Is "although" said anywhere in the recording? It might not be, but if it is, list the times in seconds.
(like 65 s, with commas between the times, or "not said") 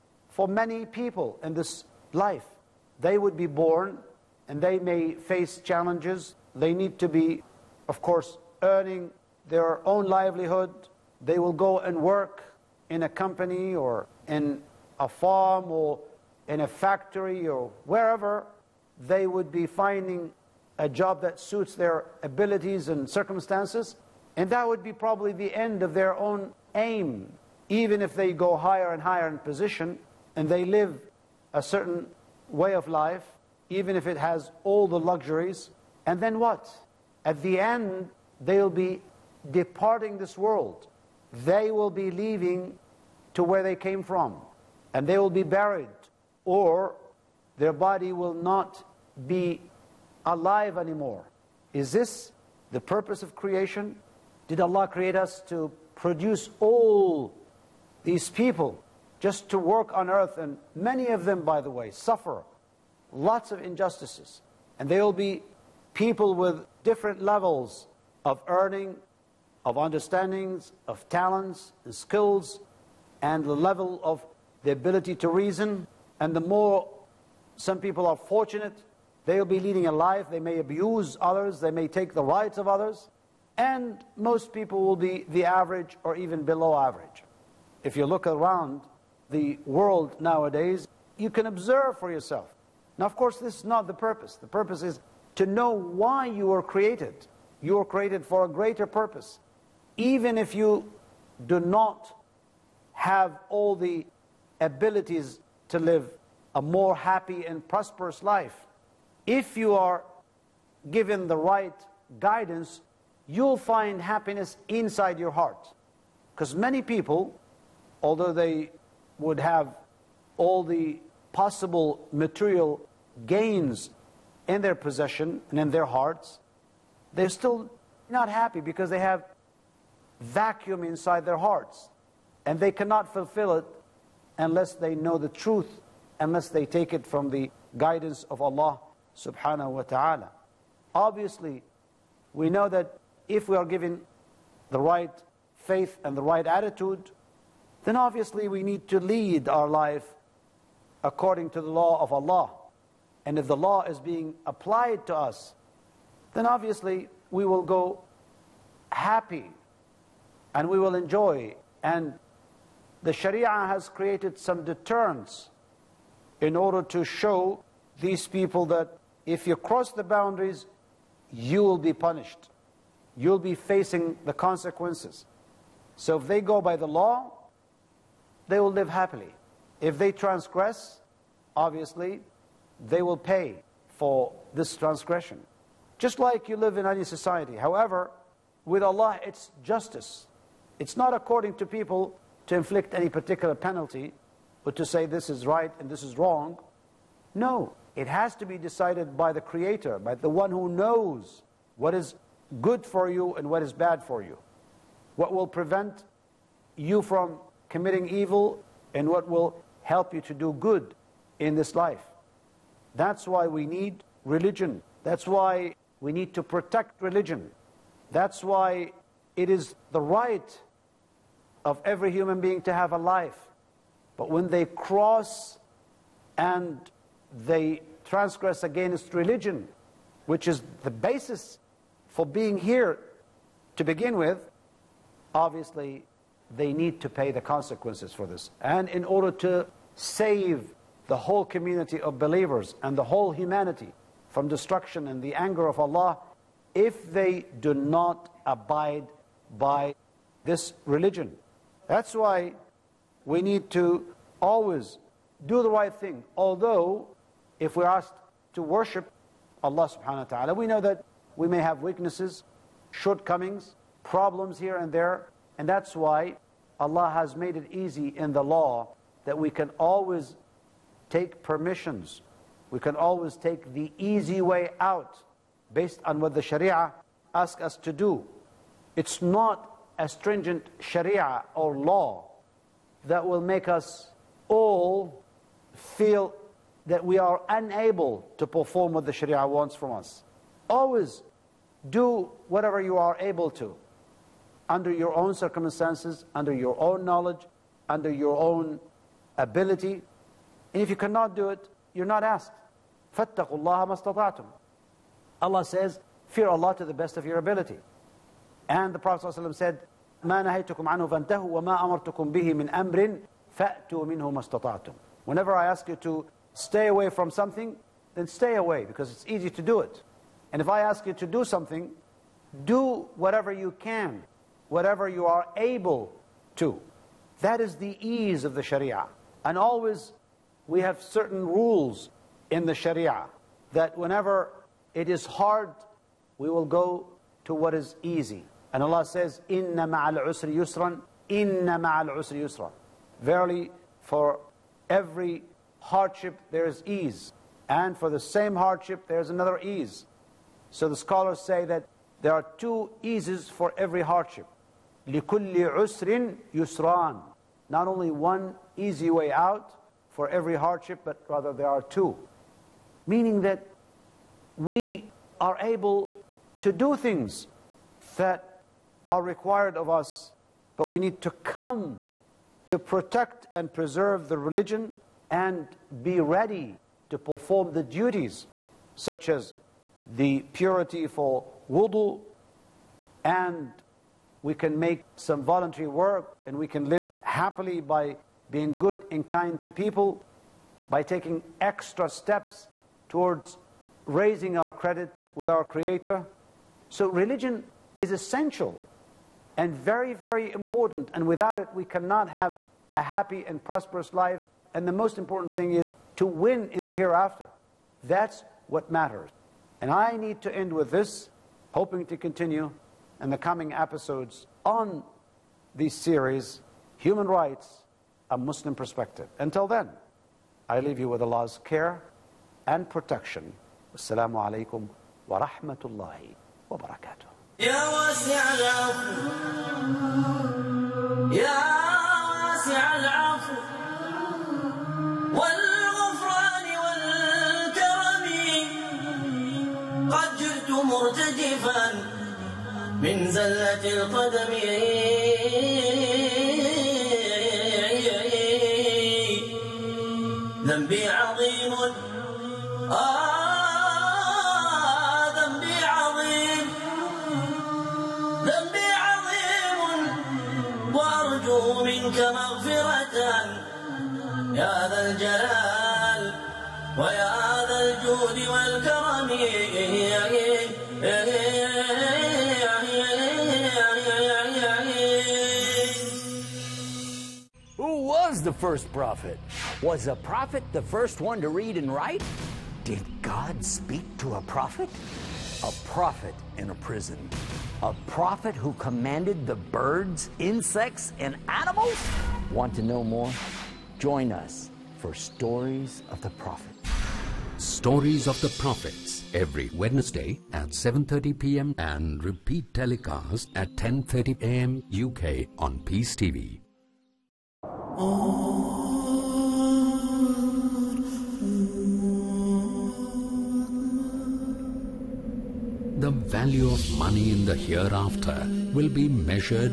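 118 s, 256 s.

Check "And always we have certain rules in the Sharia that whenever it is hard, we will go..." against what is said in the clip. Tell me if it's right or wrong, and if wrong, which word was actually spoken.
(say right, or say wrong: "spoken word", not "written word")
right.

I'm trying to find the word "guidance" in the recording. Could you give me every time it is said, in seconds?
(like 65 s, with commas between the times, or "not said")
112 s, 137 s.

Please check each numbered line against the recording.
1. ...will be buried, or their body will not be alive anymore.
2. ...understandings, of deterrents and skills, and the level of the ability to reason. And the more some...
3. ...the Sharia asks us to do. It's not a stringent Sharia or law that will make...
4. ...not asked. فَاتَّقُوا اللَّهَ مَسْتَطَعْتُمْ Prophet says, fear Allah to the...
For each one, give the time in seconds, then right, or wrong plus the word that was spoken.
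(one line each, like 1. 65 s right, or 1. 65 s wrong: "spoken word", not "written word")
1. 45 s right
2. 69 s wrong: "talents", not "deterrents"
3. 276 s right
4. 302 s wrong: "Allah", not "Prophet".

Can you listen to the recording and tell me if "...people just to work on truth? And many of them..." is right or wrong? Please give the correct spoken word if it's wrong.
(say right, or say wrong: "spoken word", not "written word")
wrong: "earth", not "truth".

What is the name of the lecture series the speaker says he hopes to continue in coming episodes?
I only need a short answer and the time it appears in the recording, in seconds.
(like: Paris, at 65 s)
Human Rights, a Muslim Perspective, at 416 s.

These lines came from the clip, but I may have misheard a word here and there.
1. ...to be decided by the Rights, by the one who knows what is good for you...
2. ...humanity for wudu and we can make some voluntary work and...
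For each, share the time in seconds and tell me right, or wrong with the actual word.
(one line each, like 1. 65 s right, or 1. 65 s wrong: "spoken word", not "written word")
1. 198 s wrong: "Creator", not "Rights"
2. 380 s wrong: "purity", not "humanity".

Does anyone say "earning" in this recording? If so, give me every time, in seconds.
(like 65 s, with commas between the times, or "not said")
8 s, 68 s.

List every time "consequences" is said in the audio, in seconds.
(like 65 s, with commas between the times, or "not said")
174 s, 237 s.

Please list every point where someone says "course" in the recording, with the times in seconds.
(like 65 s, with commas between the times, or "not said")
8 s, 93 s.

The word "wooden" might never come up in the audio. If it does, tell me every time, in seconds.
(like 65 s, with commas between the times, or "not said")
not said.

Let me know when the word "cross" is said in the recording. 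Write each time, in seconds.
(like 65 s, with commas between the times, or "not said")
169 s, 224 s.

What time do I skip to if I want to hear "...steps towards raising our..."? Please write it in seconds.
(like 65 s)
392 s.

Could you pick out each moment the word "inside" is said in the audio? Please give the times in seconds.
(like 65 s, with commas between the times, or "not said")
114 s, 130 s.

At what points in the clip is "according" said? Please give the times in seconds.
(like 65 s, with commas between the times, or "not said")
151 s, 191 s.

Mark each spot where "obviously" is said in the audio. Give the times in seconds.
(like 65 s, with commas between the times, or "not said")
140 s, 147 s, 156 s, 181 s, 235 s.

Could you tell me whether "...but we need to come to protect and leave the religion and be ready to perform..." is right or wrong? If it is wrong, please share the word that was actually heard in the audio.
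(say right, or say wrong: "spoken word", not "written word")
wrong: "preserve", not "leave".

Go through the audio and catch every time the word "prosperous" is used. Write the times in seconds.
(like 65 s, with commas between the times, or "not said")
107 s, 403 s.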